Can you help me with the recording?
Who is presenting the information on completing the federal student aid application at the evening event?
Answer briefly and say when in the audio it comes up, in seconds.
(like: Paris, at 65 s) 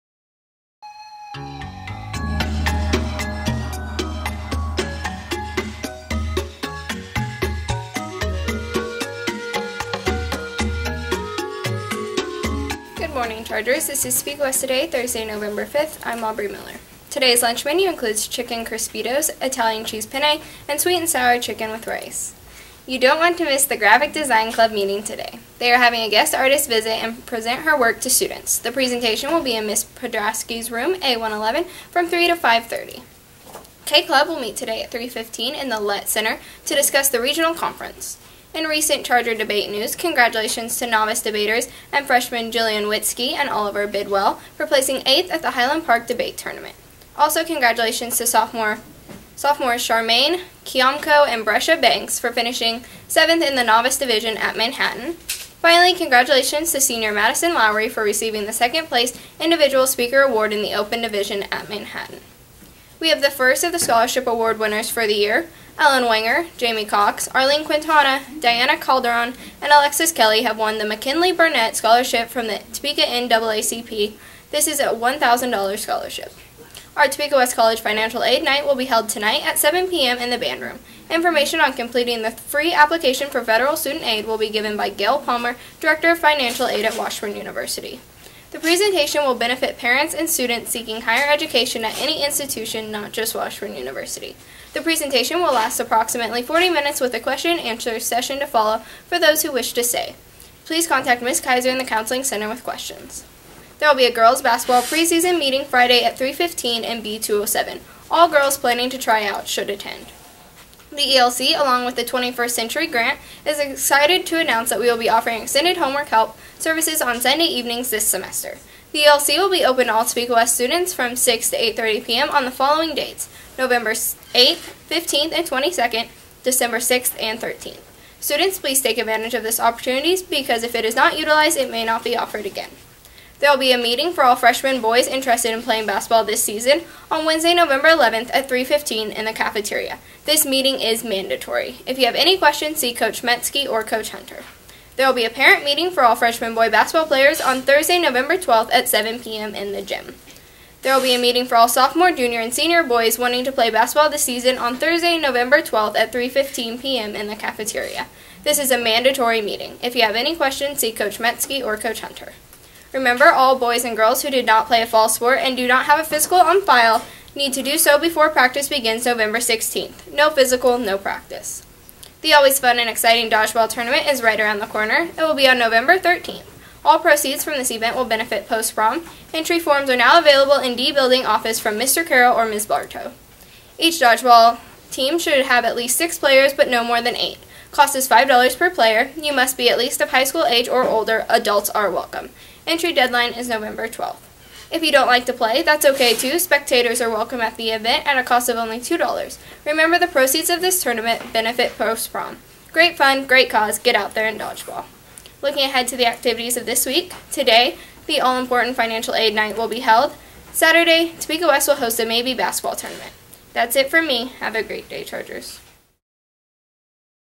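Gail Palmer, at 84 s.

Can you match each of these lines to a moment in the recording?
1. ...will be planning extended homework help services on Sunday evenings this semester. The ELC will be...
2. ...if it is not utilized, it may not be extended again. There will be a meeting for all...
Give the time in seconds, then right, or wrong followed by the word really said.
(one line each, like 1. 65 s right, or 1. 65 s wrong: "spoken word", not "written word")
1. 114 s wrong: "offering", not "planning"
2. 130 s wrong: "offered", not "extended".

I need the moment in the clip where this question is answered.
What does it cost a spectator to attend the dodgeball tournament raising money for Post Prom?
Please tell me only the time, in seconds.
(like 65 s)
198 s.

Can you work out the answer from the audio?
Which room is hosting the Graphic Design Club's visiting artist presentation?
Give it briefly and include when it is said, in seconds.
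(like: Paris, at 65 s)
A111, at 31 s.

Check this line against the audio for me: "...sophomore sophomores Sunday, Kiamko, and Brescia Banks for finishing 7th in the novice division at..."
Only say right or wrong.
wrong.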